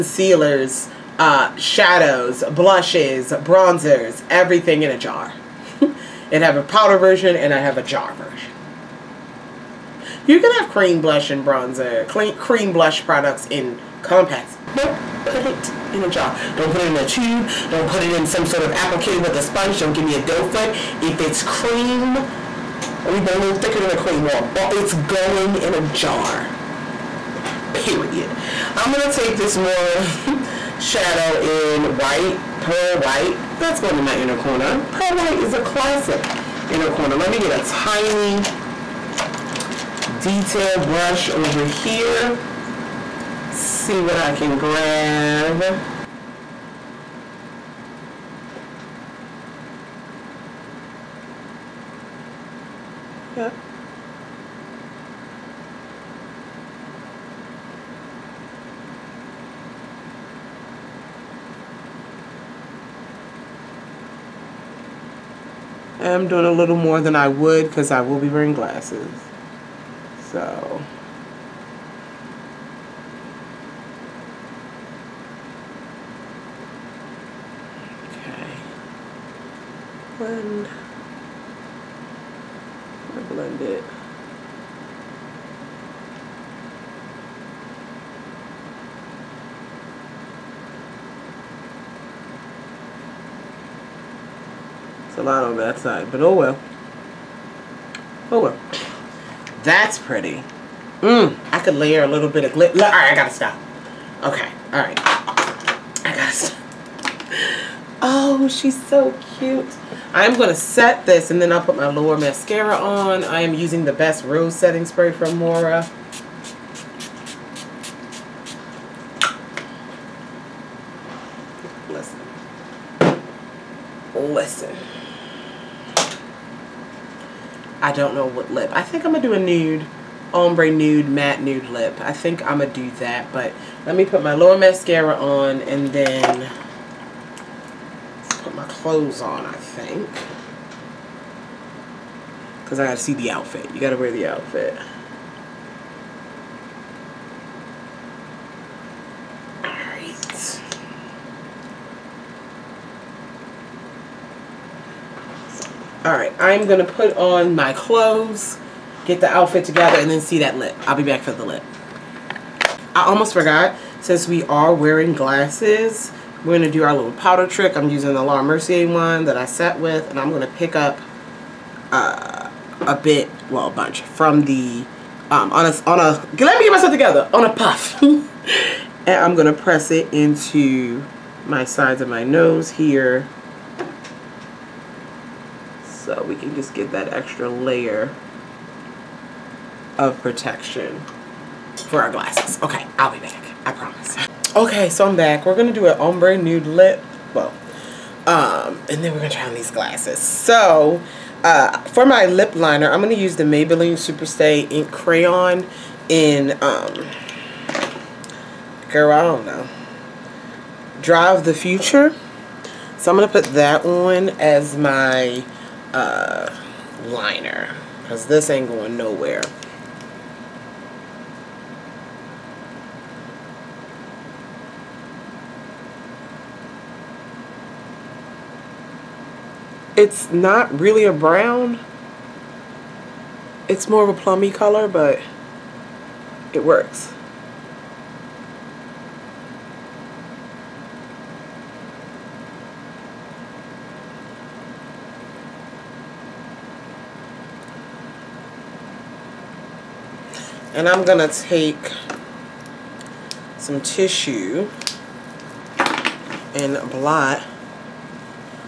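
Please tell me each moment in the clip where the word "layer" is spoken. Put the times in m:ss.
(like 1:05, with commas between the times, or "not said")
1:41, 3:07.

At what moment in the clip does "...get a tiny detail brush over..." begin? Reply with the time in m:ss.
0:37.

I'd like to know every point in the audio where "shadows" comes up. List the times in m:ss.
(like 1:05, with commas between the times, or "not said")
0:01, 0:30.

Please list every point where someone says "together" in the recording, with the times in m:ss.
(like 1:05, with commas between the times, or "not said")
2:39, 2:56.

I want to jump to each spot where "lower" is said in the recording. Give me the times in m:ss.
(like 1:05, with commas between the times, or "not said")
1:51, 2:14.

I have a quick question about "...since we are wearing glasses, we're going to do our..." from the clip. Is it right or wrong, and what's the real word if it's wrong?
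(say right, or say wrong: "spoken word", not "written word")
right.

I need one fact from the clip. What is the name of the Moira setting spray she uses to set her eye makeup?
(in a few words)
Best Rose Setting Spray.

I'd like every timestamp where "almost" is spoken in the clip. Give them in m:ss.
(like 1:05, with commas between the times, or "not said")
2:43.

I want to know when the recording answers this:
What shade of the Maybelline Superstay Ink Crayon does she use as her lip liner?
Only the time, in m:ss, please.
3:31.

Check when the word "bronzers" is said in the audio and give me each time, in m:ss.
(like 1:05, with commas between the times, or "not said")
0:03, 0:11.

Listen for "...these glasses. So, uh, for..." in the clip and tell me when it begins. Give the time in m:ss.
3:19.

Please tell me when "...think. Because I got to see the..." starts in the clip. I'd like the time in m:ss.
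2:19.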